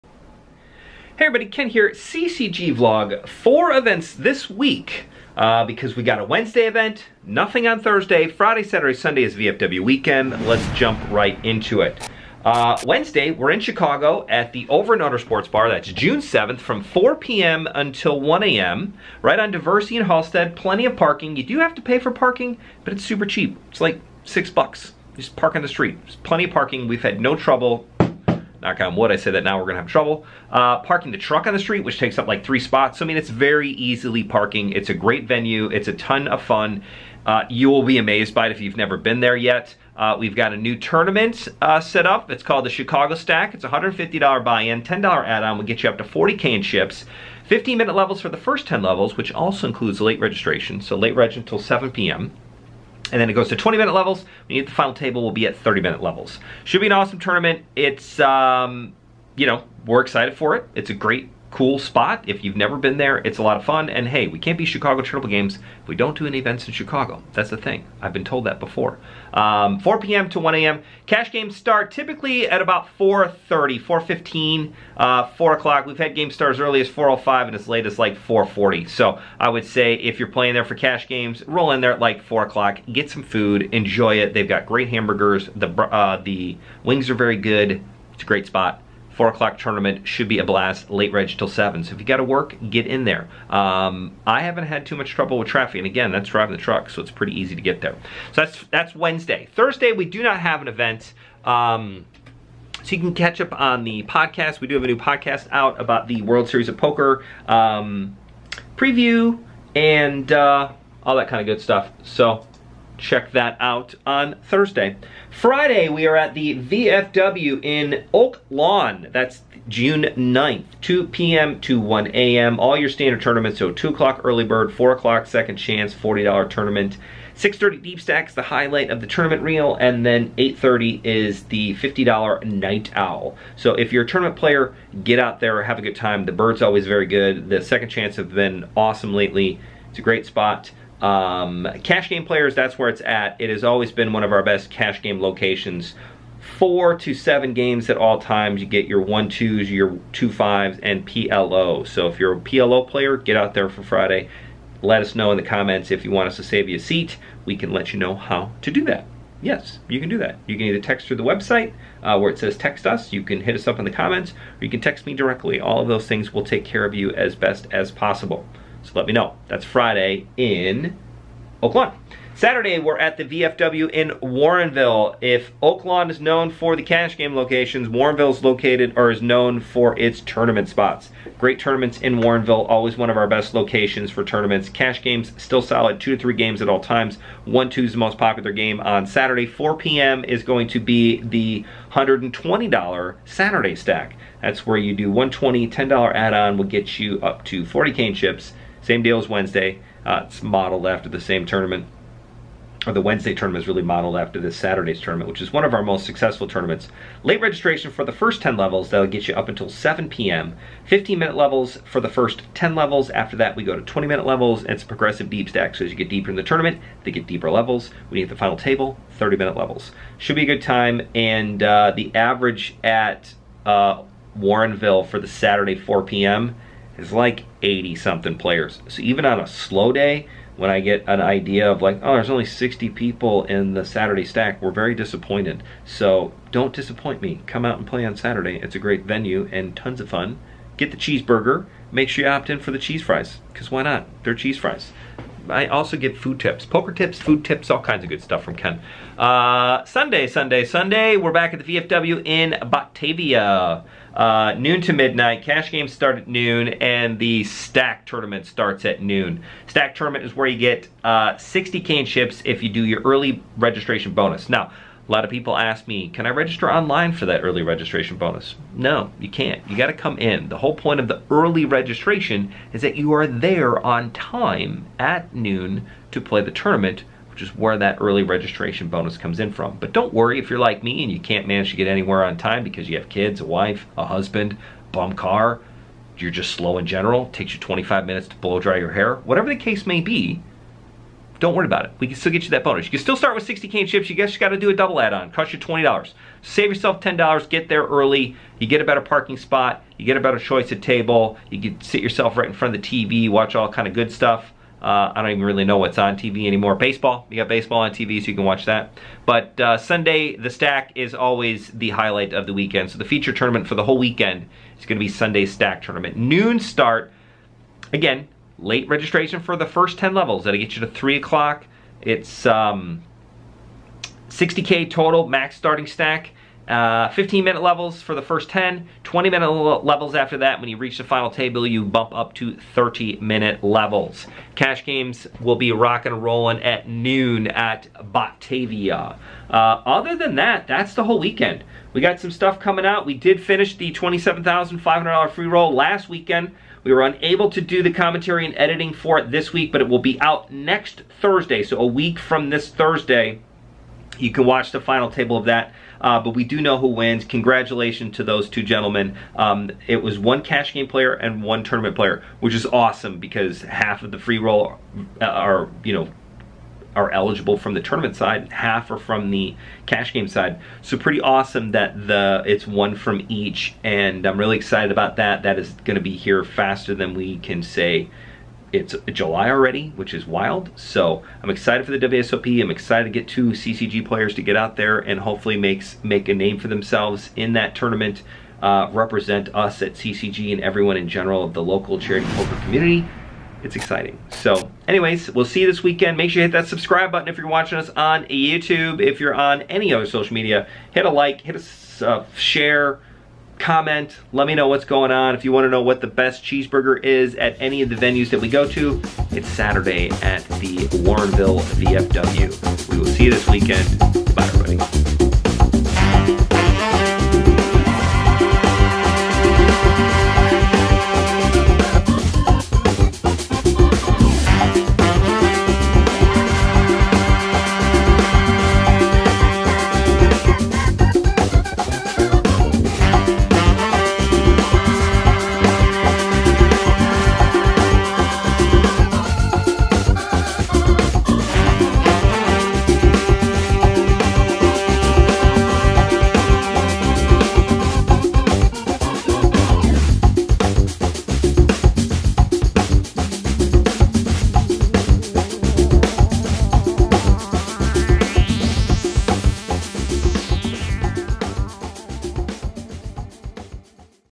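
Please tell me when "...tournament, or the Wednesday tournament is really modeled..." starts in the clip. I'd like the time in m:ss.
3:21.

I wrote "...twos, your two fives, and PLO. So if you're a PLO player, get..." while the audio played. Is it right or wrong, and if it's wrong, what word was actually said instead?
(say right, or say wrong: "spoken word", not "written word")
right.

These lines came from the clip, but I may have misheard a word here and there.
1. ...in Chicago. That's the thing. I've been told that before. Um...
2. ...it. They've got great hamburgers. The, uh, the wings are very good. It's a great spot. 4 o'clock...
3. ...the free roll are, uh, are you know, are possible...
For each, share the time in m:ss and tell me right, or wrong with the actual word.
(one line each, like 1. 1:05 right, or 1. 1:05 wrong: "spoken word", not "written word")
1. 1:06 right
2. 1:24 right
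3. 6:04 wrong: "eligible", not "possible".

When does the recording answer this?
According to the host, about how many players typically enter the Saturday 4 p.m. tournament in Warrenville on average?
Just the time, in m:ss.
3:47.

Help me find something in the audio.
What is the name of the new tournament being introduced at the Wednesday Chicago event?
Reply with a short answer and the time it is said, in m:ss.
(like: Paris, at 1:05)
Chicago Stack, at 0:42.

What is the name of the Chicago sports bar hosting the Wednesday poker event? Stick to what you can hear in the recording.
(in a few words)
Over and Under Sports Bar.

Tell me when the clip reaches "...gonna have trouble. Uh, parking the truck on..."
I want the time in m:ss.
0:29.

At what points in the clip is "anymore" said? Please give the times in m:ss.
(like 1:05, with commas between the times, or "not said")
5:06.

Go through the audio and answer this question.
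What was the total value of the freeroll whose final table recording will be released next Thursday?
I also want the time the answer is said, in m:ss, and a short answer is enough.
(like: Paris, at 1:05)
$27,500, at 5:43.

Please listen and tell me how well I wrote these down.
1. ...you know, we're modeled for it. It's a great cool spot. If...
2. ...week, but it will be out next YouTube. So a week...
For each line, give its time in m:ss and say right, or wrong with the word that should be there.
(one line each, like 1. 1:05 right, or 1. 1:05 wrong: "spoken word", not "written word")
1. 0:59 wrong: "excited", not "modeled"
2. 5:49 wrong: "Thursday", not "YouTube".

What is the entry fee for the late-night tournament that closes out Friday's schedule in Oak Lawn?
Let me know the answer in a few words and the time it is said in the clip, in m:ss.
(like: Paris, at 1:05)
$50, at 2:11.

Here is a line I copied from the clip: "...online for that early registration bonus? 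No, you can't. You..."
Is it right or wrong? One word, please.
right.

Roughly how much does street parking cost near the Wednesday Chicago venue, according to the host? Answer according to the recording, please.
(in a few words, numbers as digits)
$6.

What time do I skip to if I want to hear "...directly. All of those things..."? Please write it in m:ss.
2:45.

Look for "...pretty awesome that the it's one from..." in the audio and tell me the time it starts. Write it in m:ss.
6:10.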